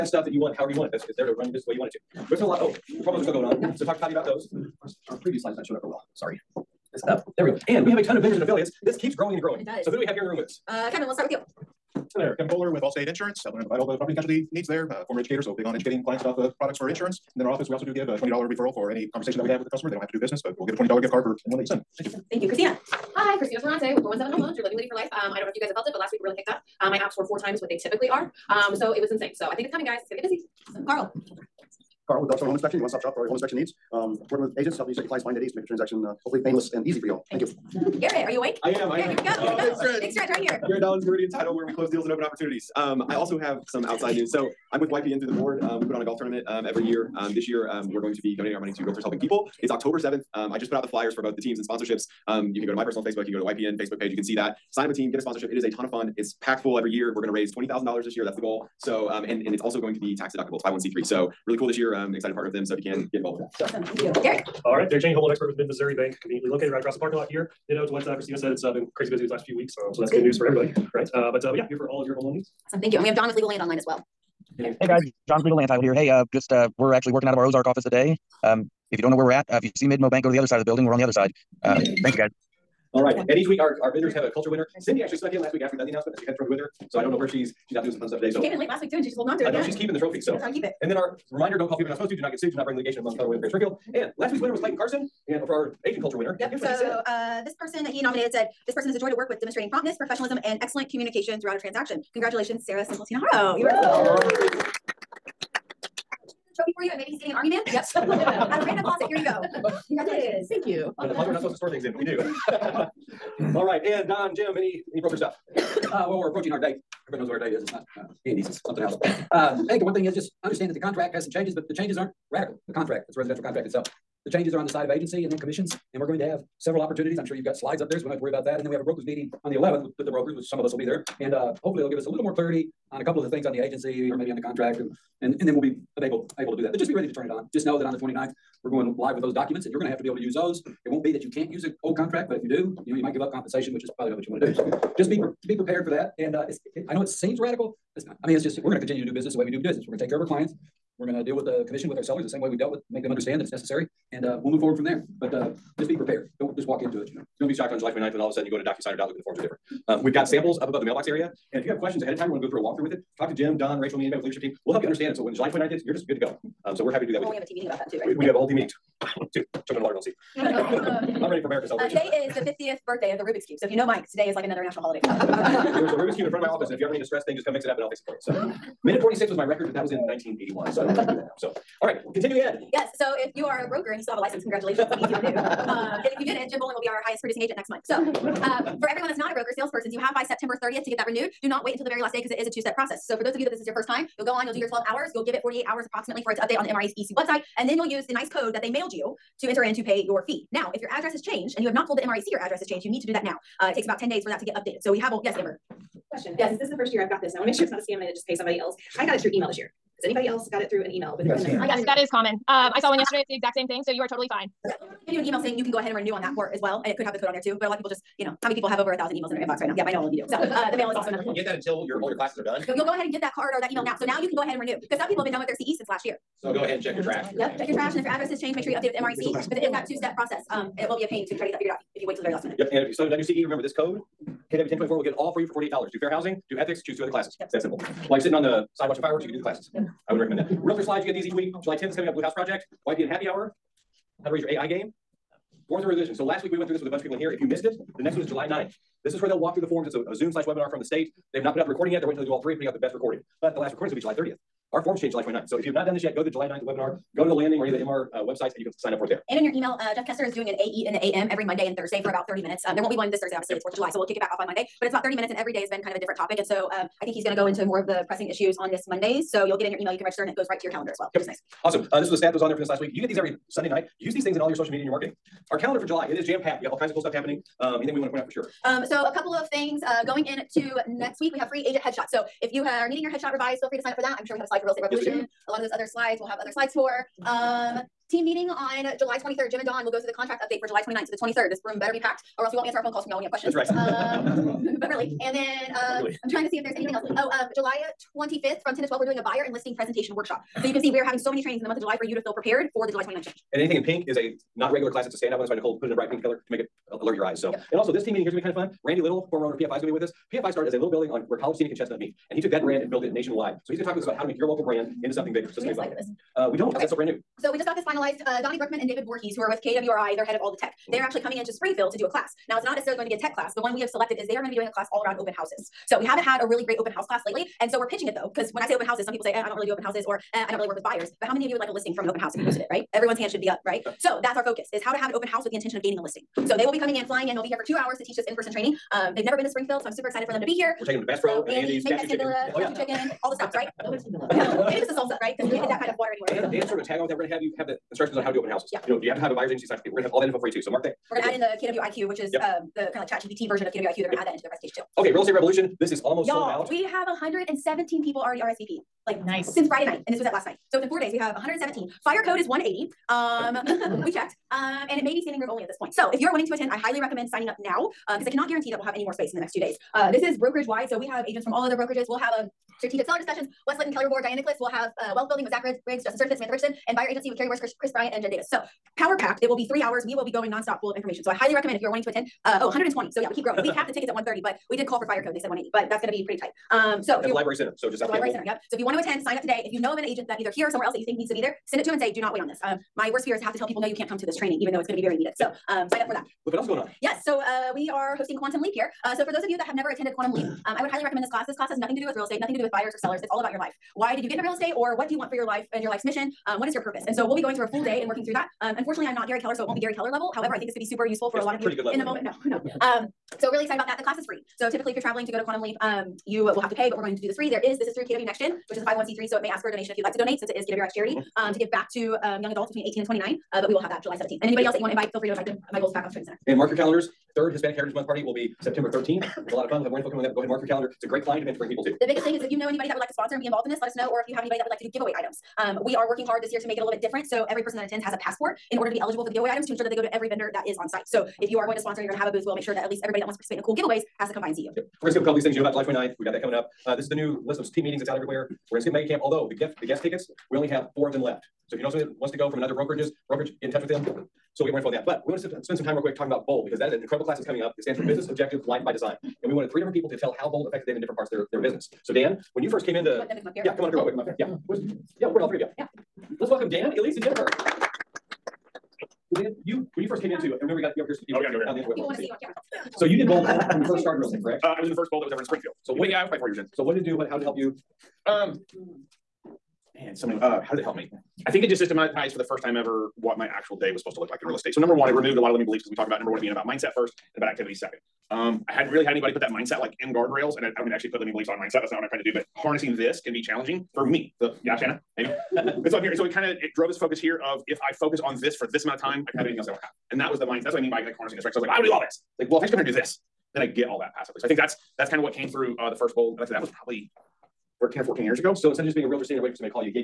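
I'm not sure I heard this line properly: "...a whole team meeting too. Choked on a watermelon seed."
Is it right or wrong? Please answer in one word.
right.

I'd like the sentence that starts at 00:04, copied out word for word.
Our, our previous slide is not showing up very well.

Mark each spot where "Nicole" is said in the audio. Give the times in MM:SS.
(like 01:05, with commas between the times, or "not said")
05:05.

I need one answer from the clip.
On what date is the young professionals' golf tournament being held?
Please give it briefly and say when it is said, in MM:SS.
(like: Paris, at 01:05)
October 7th, at 00:49.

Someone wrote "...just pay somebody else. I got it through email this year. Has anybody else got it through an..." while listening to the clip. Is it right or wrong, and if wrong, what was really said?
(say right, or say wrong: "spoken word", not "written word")
right.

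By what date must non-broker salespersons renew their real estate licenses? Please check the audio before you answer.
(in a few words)
September 30th.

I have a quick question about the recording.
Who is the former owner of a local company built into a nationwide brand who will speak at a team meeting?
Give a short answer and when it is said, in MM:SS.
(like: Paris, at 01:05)
Randy Little, at 05:08.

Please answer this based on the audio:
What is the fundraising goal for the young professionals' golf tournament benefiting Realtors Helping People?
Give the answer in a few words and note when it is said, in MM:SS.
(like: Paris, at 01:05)
$20,000, at 00:57.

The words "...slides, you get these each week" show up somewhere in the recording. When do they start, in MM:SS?
04:00.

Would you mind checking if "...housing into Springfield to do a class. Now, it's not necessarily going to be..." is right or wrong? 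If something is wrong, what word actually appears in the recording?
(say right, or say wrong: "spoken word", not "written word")
wrong: "coming", not "housing".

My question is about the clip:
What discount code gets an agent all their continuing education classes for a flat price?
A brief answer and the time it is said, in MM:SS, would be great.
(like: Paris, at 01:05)
KW1024, at 03:54.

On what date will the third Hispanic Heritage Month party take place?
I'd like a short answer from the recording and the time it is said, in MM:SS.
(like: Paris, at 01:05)
September 13th, at 07:08.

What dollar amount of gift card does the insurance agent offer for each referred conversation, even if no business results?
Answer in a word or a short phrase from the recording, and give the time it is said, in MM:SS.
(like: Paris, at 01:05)
$20, at 00:20.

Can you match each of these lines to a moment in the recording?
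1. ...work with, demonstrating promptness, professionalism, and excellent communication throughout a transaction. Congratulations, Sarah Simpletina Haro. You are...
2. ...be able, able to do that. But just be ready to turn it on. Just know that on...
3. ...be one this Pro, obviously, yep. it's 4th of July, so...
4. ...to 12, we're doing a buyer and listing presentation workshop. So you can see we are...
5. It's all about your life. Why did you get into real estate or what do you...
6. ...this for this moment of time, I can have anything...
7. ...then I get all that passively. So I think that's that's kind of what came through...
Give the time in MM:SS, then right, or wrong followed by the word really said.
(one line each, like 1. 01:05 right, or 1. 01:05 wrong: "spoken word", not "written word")
1. 01:39 right
2. 02:15 right
3. 04:22 wrong: "Thursday", not "Pro"
4. 04:58 right
5. 06:43 right
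6. 08:18 wrong: "amount", not "moment"
7. 08:23 right.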